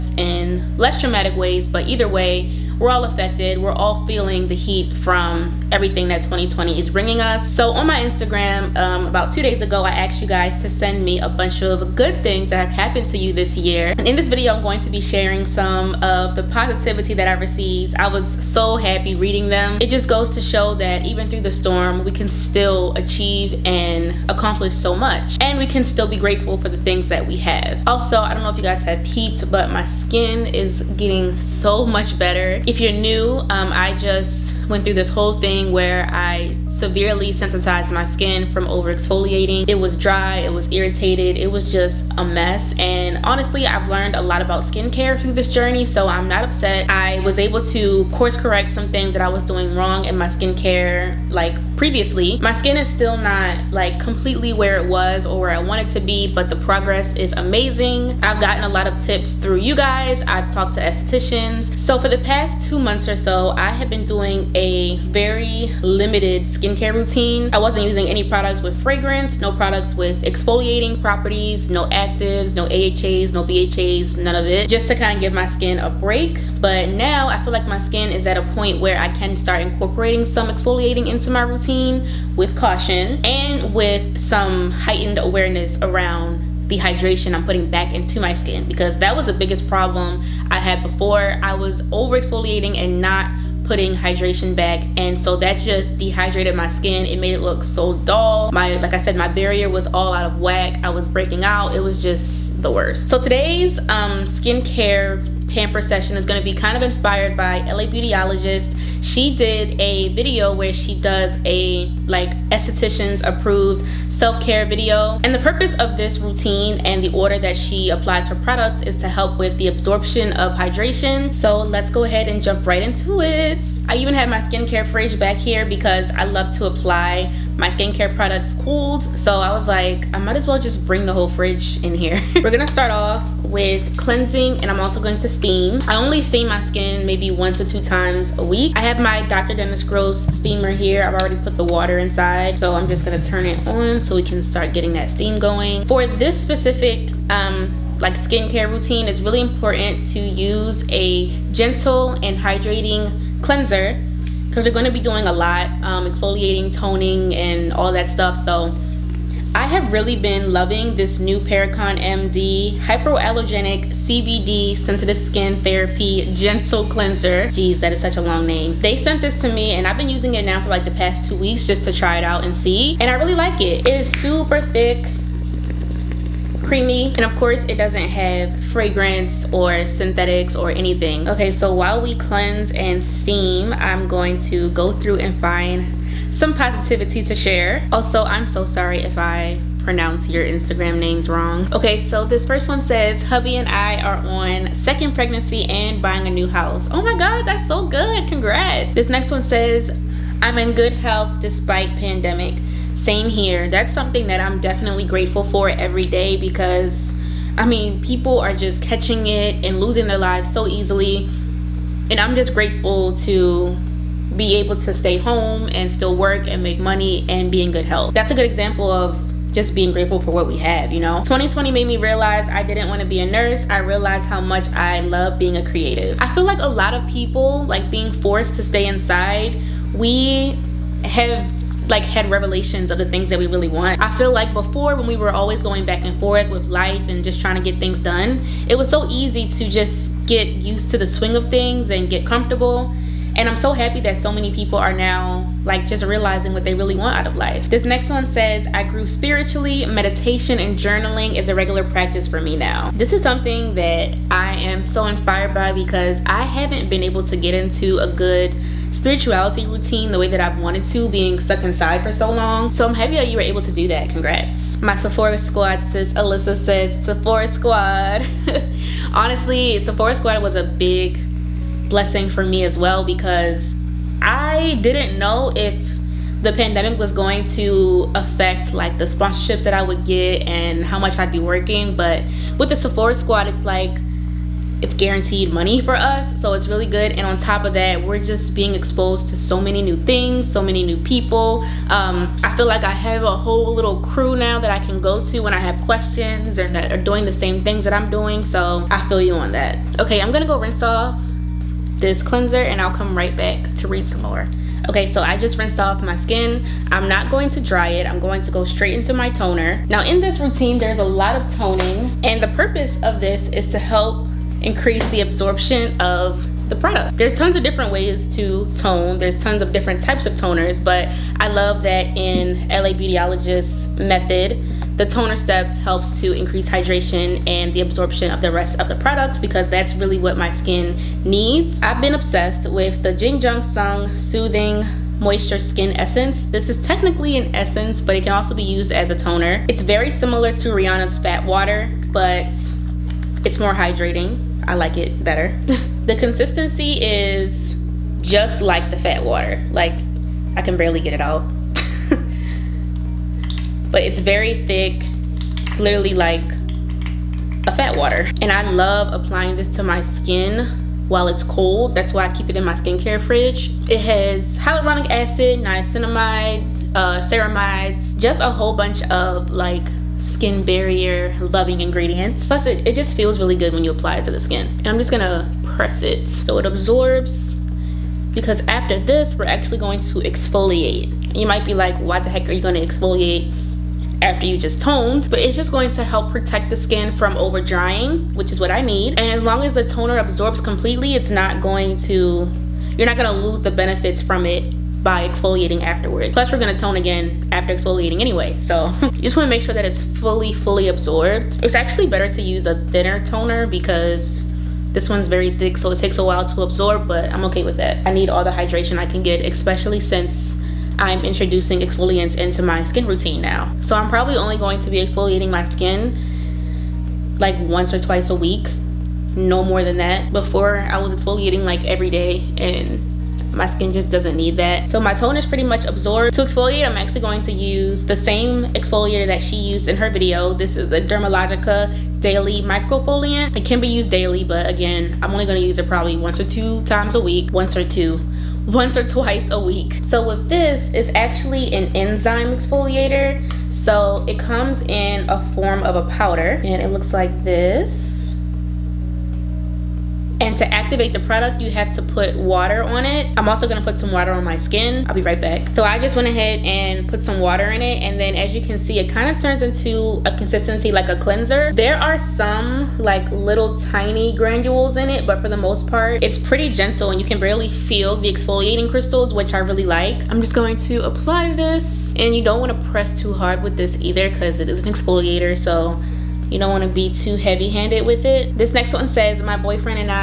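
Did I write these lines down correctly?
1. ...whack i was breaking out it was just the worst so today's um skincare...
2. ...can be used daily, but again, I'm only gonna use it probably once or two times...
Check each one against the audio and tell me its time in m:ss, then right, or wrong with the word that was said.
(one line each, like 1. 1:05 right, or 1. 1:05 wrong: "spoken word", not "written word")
1. 1:40 right
2. 7:13 right.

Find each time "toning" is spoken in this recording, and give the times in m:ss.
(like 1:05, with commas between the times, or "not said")
2:36, 5:11.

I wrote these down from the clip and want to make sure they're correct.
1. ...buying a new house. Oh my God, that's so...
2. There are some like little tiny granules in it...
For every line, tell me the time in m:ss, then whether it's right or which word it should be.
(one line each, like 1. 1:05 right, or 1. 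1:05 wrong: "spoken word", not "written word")
1. 3:16 right
2. 7:41 right.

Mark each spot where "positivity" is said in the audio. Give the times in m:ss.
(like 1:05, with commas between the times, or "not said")
0:16, 3:06.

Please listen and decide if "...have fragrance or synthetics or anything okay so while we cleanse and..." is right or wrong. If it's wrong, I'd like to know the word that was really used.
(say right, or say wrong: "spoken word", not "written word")
right.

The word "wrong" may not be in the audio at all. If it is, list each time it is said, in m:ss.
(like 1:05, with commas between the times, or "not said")
0:49, 3:11.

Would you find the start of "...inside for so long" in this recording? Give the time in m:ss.
4:21.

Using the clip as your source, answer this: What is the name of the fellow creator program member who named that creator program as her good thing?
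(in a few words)
Alyssa.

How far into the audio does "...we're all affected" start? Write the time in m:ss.
0:02.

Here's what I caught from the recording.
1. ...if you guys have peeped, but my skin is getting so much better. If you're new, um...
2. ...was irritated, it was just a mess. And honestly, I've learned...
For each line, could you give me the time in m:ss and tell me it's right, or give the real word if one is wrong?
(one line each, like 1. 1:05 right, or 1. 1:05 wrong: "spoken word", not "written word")
1. 0:28 right
2. 0:40 right.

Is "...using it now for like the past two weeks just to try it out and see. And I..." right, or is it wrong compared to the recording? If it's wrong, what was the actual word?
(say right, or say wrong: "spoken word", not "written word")
right.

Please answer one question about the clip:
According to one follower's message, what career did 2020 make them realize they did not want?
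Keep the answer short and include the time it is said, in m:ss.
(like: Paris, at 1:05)
nurse, at 3:43.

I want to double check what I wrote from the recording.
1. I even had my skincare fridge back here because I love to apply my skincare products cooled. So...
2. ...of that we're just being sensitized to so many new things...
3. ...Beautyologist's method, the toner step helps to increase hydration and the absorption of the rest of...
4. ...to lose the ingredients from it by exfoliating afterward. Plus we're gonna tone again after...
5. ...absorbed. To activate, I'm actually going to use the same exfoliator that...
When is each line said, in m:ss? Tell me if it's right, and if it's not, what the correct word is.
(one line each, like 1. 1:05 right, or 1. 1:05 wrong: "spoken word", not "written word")
1. 2:03 right
2. 4:47 wrong: "exposed", not "sensitized"
3. 5:22 right
4. 6:33 wrong: "benefits", not "ingredients"
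5. 7:05 wrong: "exfoliate", not "activate".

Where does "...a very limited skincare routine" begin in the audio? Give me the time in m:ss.
1:04.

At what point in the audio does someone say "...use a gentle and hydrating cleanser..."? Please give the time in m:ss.
2:30.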